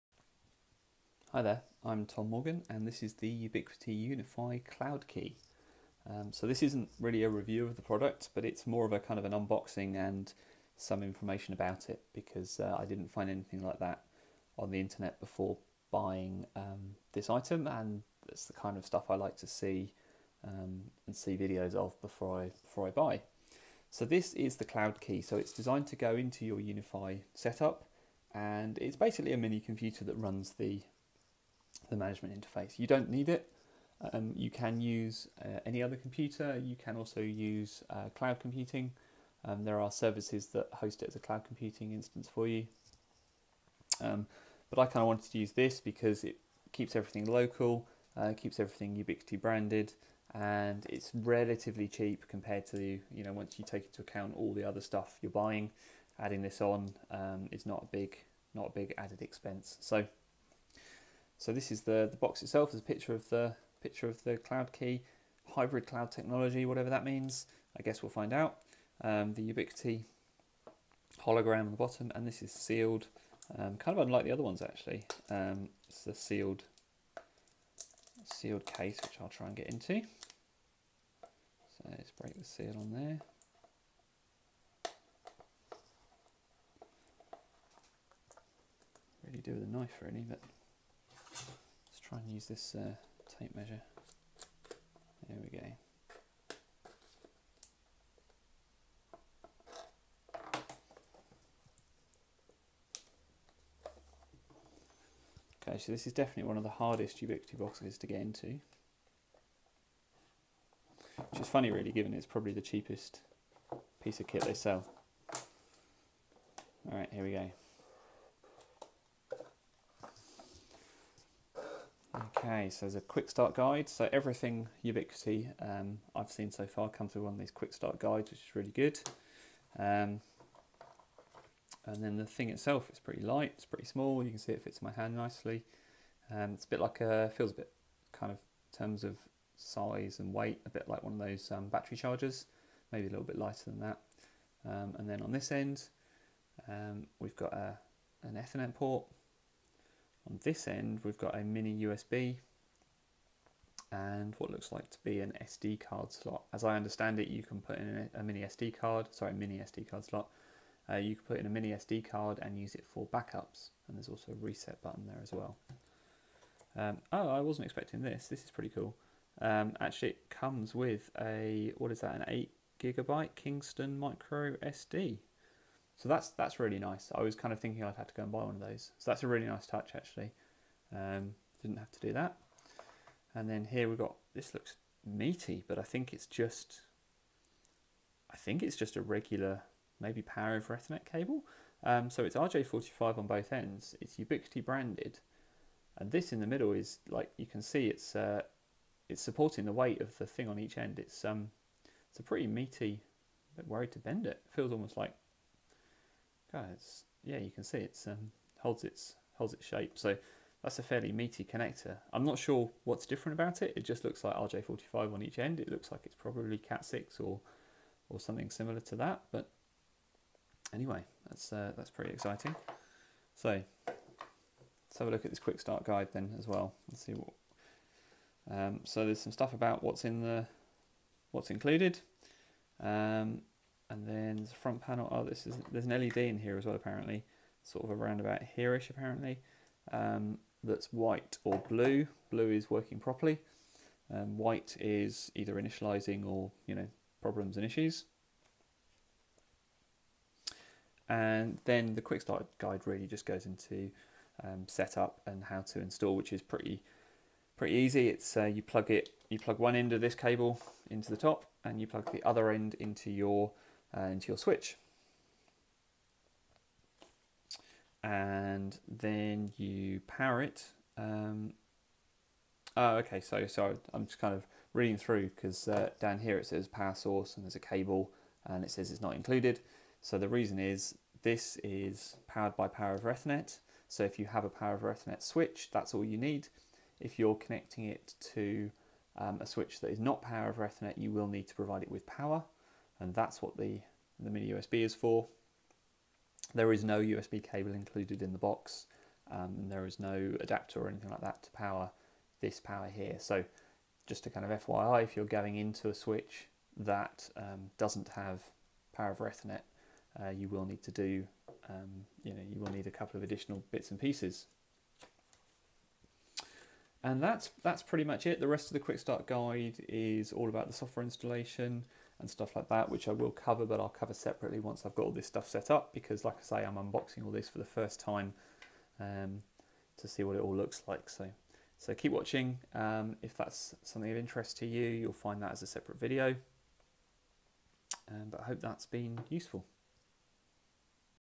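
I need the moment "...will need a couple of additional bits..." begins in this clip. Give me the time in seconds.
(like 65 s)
312 s.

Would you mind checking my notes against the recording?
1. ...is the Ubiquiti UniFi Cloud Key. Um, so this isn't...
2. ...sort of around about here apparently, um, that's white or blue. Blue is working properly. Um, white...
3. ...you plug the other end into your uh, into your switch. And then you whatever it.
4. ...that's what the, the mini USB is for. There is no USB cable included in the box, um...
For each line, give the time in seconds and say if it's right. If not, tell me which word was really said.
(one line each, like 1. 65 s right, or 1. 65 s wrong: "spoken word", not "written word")
1. 3 s right
2. 237 s right
3. 261 s wrong: "power", not "whatever"
4. 293 s right.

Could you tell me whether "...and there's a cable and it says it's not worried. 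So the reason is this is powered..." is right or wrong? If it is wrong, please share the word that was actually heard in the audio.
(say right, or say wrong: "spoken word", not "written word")
wrong: "included", not "worried".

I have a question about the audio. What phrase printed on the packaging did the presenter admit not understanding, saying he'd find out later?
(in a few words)
Hybrid cloud technology.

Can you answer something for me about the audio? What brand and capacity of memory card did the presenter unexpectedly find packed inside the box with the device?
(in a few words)
8 gigabyte Kingston.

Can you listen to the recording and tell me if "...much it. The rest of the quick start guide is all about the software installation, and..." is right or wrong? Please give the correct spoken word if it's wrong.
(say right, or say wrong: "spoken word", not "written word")
right.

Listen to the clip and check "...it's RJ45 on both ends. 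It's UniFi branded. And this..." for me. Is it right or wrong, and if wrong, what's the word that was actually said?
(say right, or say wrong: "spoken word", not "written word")
wrong: "Ubiquiti", not "UniFi".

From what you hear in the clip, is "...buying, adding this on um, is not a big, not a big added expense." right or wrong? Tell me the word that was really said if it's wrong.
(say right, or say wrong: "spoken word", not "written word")
right.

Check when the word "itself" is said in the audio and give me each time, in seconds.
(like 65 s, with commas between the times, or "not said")
62 s, 132 s.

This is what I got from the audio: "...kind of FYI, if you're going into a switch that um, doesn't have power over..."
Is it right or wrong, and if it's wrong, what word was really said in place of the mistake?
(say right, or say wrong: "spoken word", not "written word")
right.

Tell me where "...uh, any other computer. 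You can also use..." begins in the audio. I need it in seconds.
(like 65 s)
35 s.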